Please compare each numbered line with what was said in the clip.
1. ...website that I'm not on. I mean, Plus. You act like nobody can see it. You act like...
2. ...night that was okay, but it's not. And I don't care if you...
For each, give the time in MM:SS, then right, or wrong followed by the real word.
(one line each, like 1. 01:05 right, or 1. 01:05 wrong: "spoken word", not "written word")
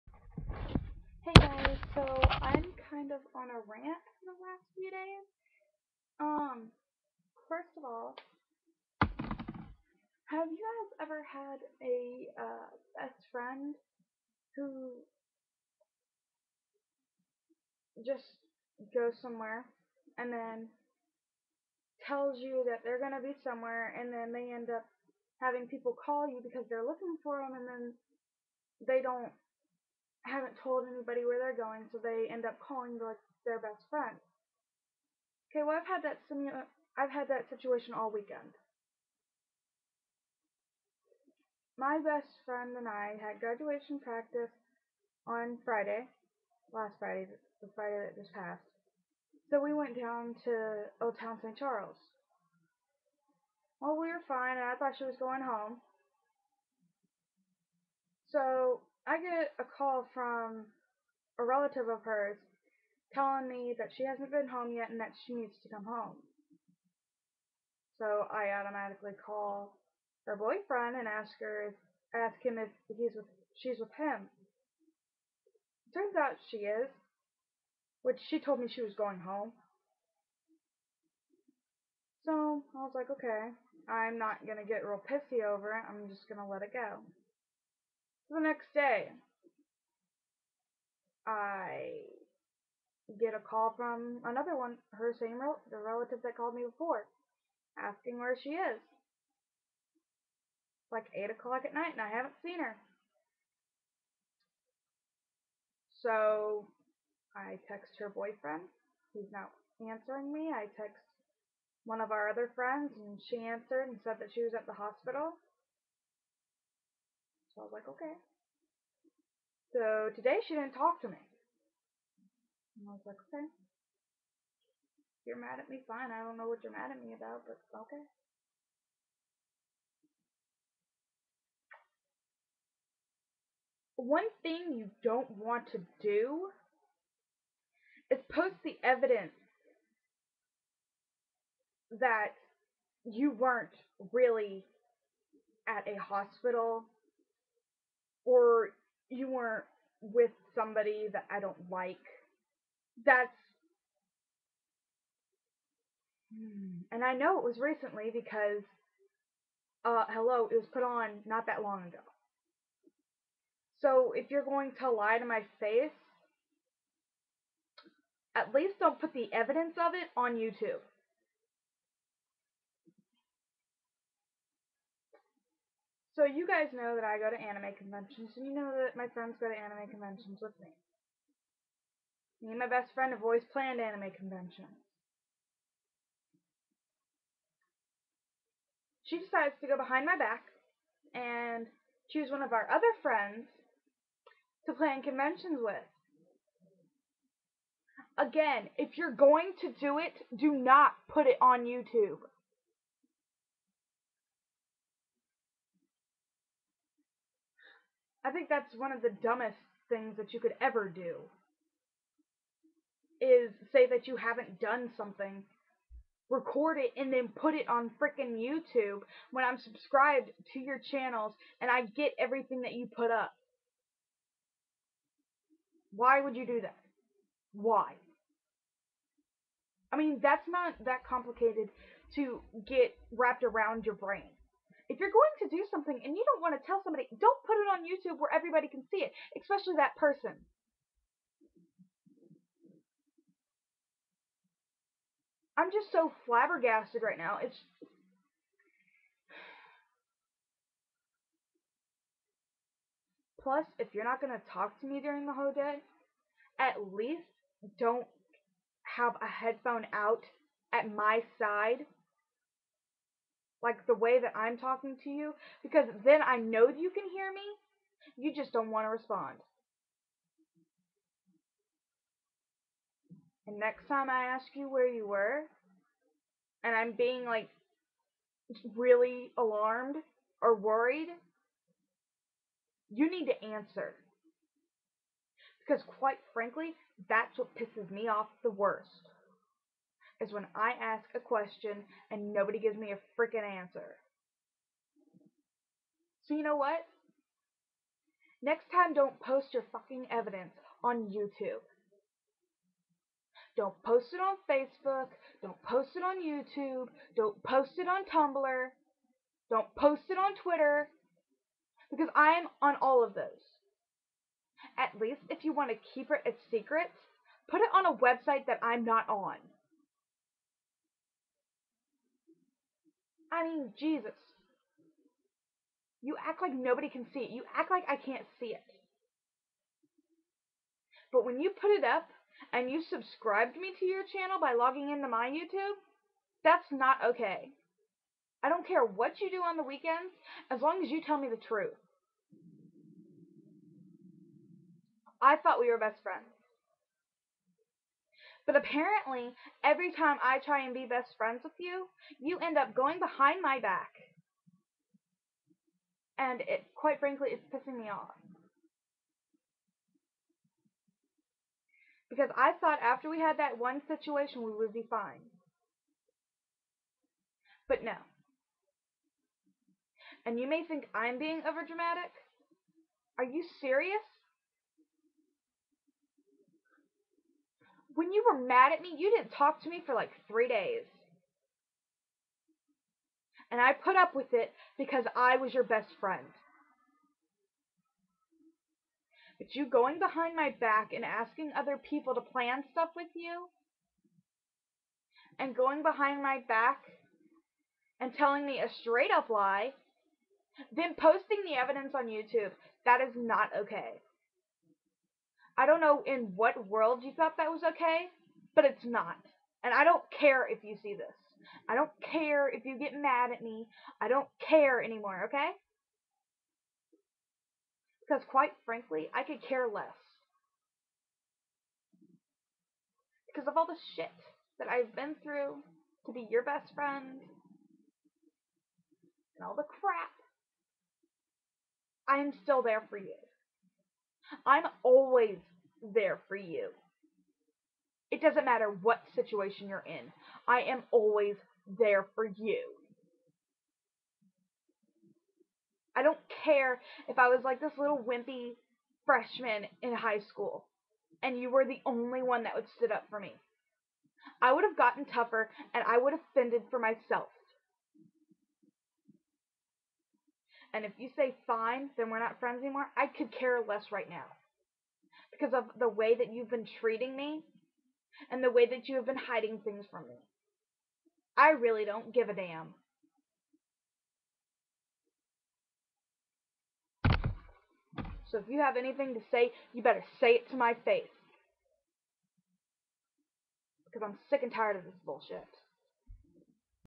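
1. 05:17 wrong: "Jesus", not "Plus"
2. 06:47 wrong: "thought", not "night".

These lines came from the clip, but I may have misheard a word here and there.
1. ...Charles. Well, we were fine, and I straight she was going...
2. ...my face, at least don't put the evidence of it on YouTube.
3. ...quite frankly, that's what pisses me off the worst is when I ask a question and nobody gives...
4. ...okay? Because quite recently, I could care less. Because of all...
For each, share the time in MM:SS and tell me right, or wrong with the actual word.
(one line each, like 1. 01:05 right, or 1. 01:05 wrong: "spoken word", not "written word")
1. 00:51 wrong: "thought", not "straight"
2. 02:45 right
3. 04:45 right
4. 06:55 wrong: "frankly", not "recently".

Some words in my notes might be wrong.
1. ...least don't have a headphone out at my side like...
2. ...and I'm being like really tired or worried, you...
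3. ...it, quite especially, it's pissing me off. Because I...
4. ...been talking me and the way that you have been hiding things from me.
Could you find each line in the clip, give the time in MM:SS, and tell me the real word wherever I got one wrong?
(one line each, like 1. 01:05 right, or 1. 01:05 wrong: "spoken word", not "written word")
1. 04:16 right
2. 04:36 wrong: "alarmed", not "tired"
3. 05:56 wrong: "frankly", not "especially"
4. 07:46 wrong: "treating", not "talking".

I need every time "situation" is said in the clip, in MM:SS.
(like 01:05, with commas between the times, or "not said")
00:37, 06:03, 07:19.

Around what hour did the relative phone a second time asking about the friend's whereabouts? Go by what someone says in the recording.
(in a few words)
8 o'clock.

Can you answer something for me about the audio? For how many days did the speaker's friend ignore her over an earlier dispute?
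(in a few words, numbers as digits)
3.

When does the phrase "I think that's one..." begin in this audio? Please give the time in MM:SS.
03:28.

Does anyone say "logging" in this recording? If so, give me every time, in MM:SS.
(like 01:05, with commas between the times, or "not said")
05:34.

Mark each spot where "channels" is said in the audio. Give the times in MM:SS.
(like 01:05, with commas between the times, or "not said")
03:40, 05:34.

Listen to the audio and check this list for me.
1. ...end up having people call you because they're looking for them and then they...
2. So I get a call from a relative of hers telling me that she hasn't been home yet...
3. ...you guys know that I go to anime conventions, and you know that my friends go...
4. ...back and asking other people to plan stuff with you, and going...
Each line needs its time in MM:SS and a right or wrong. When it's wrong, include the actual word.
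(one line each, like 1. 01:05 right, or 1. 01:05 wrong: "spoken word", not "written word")
1. 00:24 right
2. 00:58 right
3. 02:56 right
4. 06:30 right.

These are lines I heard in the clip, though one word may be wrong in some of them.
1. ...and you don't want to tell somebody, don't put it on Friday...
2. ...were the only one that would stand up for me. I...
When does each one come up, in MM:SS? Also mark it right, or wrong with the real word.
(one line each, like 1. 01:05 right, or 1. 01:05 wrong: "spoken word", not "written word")
1. 03:56 wrong: "YouTube", not "Friday"
2. 07:31 right.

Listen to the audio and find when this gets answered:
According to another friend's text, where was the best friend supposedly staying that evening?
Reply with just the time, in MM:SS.
01:54.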